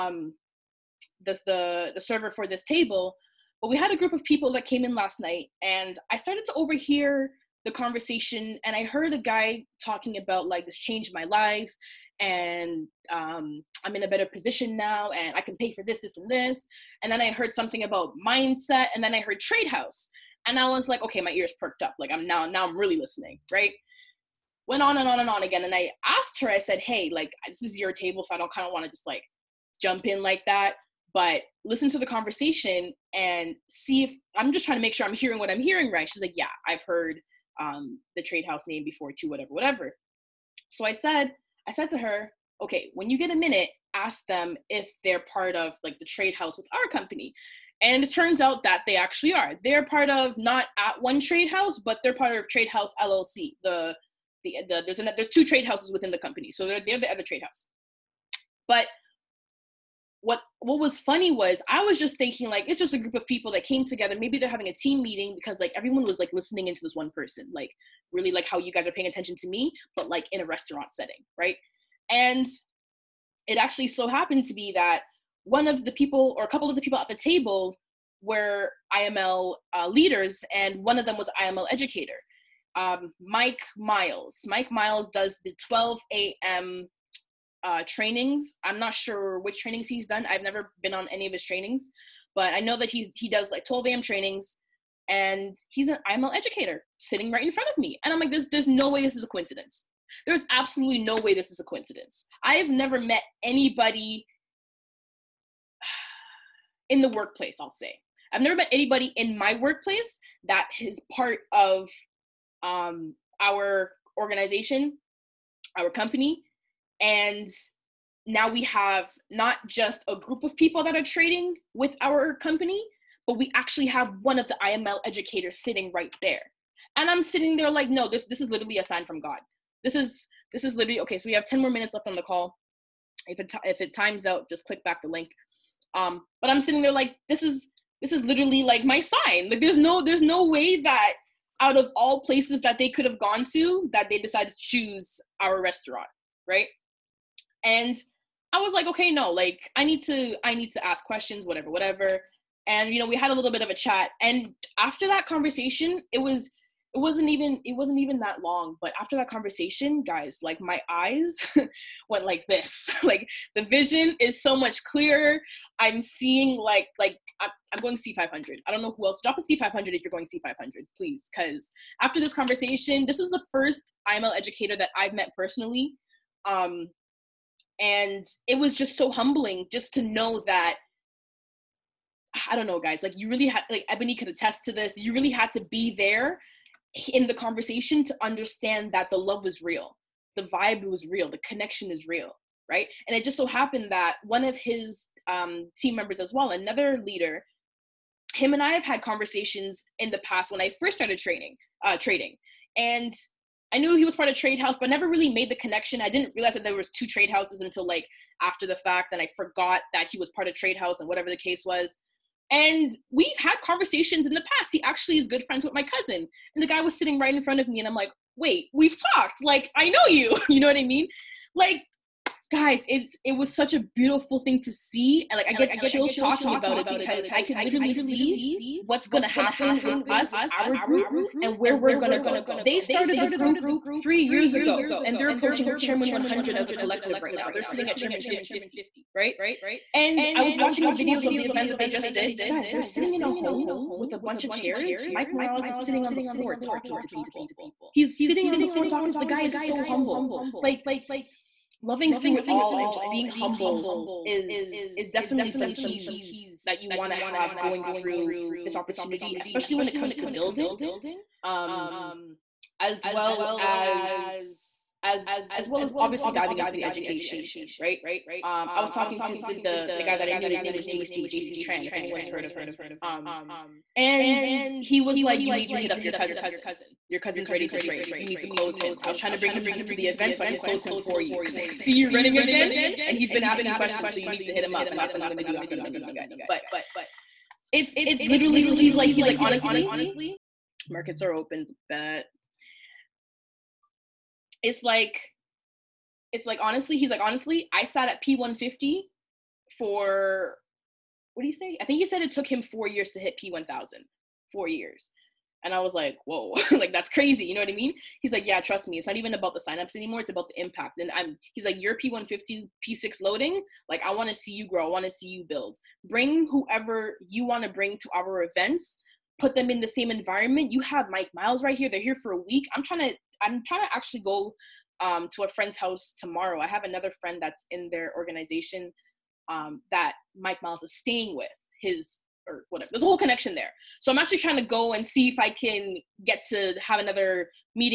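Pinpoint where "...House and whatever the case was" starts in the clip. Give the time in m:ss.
3:30.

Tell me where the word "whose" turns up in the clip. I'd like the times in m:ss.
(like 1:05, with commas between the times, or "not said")
not said.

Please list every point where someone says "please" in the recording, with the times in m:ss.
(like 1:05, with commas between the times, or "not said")
2:50.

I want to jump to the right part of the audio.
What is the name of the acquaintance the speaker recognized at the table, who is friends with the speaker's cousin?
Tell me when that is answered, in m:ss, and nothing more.
4:30.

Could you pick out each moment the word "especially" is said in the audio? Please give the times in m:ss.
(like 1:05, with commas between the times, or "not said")
4:19.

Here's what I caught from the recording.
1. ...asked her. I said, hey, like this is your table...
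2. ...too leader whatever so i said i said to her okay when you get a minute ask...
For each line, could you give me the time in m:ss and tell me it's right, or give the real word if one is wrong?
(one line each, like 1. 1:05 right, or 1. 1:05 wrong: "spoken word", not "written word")
1. 0:26 right
2. 0:39 wrong: "whatever", not "leader".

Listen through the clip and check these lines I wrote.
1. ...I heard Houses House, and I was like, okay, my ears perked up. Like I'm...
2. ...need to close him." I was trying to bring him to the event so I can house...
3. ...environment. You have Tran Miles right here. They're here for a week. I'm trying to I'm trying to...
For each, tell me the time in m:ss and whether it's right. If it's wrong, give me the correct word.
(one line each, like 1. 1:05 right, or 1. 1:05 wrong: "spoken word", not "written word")
1. 0:19 wrong: "Trade", not "Houses"
2. 4:38 wrong: "close", not "house"
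3. 5:20 wrong: "Mike", not "Tran".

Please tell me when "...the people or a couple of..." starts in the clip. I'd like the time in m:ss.
1:15.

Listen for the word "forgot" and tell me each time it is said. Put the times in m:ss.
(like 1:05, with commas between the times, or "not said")
3:29.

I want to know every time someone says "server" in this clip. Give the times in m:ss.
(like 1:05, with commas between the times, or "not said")
0:01.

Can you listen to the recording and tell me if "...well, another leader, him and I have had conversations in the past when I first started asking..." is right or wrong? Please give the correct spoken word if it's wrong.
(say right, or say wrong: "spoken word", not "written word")
wrong: "training", not "asking".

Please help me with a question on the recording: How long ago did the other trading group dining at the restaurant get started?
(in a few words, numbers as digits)
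three years ago.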